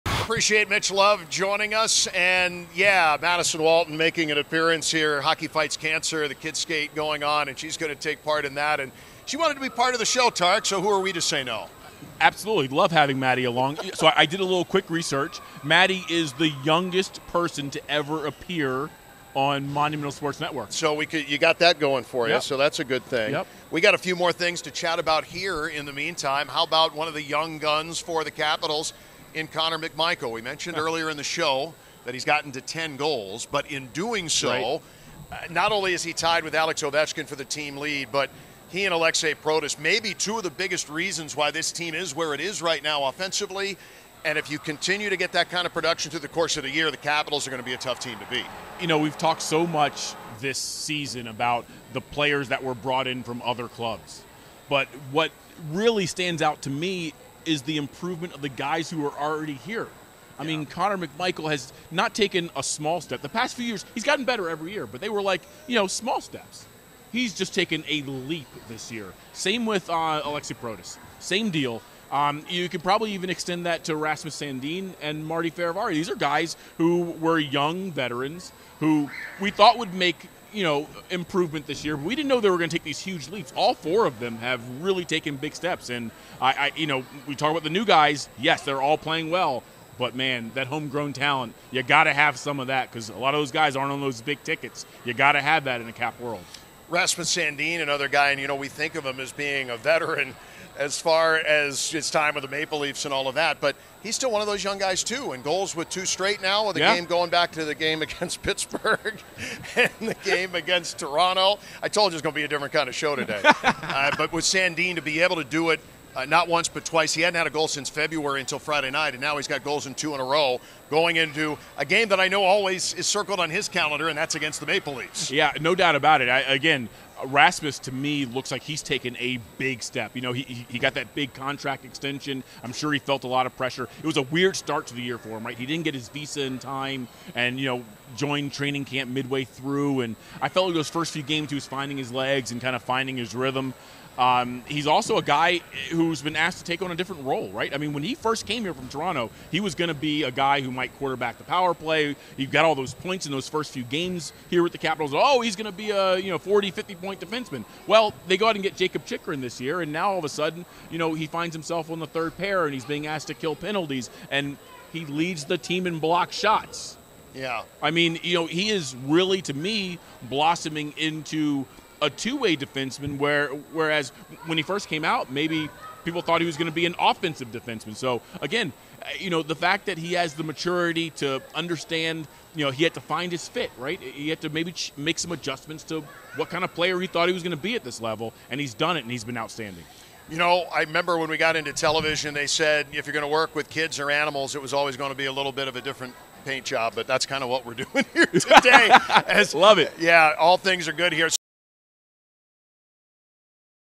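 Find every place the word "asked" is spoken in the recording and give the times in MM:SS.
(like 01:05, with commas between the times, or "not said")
02:26, 02:43.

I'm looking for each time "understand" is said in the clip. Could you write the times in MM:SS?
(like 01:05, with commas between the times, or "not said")
03:01.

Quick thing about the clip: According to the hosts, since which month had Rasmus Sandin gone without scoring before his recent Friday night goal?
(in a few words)
February.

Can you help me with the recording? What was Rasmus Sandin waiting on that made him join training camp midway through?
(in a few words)
his visa.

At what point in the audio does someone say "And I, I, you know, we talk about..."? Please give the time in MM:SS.
01:25.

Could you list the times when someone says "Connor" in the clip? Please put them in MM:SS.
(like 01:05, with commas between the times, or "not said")
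00:29, 01:00.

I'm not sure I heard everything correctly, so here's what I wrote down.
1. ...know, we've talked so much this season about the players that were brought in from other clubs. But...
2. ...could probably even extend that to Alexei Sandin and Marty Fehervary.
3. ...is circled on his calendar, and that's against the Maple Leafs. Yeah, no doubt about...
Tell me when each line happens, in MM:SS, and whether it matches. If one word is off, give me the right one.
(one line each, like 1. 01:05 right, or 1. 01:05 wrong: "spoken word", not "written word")
1. 00:48 right
2. 01:12 wrong: "Rasmus", not "Alexei"
3. 02:02 right.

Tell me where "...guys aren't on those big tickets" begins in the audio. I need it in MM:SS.
01:33.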